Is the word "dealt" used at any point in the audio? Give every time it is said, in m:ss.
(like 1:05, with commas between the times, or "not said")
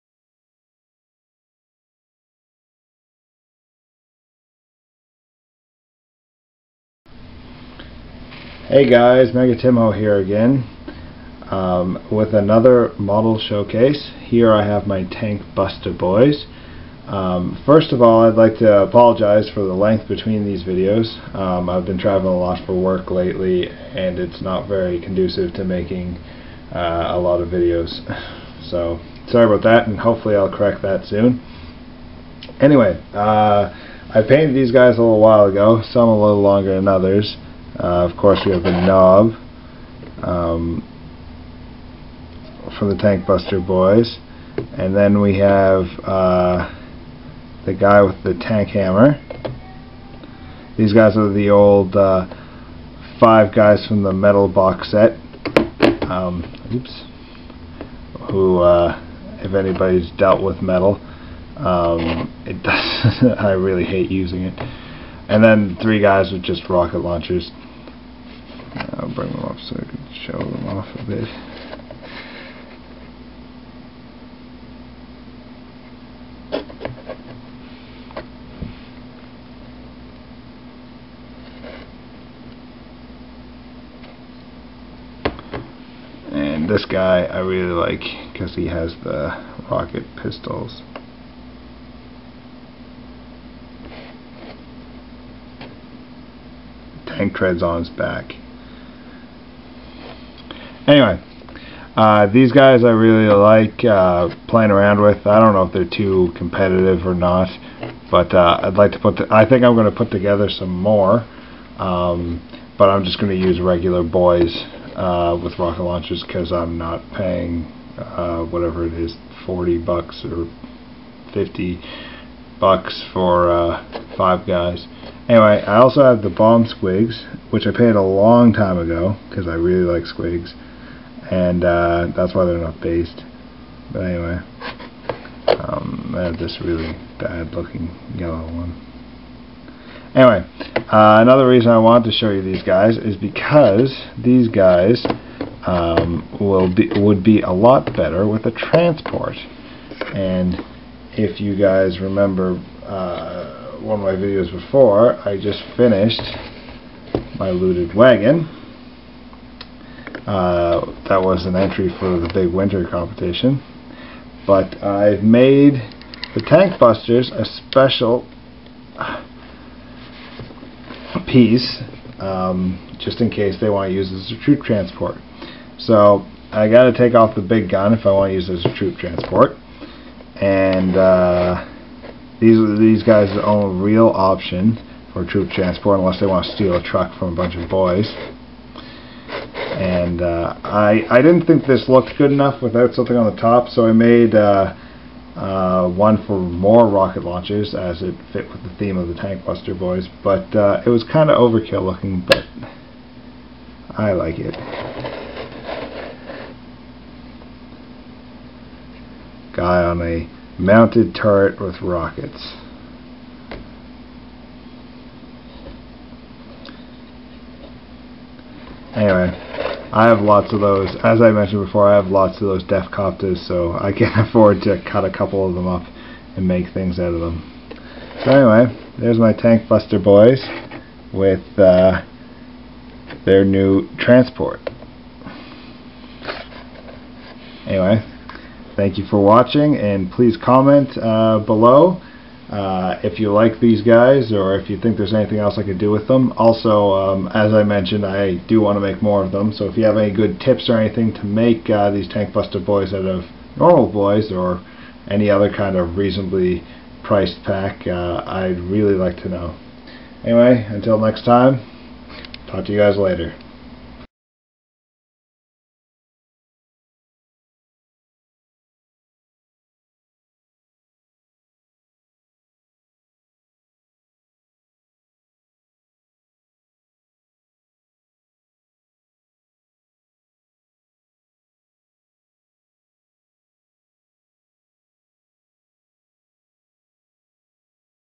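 1:00.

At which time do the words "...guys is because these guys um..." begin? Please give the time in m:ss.
2:22.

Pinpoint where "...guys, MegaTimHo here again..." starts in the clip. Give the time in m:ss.
0:08.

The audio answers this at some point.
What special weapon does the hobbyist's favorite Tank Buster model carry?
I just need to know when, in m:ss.
1:29.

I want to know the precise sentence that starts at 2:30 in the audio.
And if you guys remember uh, one of my videos before, I just finished my looted wagon.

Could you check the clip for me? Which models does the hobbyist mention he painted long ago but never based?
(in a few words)
Bomb squigs.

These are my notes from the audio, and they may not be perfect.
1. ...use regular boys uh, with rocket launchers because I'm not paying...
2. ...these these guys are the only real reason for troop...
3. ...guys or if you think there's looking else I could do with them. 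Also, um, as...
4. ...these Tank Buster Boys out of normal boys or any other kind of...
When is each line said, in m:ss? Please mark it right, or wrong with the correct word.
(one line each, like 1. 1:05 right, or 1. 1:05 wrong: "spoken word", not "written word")
1. 1:53 right
2. 3:02 wrong: "option", not "reason"
3. 4:03 wrong: "anything", not "looking"
4. 4:11 right.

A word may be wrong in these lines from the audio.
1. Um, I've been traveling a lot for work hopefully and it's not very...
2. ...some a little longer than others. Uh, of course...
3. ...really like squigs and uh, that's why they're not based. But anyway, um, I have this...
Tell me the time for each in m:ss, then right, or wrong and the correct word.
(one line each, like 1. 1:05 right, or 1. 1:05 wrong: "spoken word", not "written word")
1. 0:21 wrong: "lately", not "hopefully"
2. 0:35 right
3. 2:09 right.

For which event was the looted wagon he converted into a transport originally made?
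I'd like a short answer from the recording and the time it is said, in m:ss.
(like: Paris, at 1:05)
Big winter competition, at 2:42.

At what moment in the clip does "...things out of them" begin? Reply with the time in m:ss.
3:46.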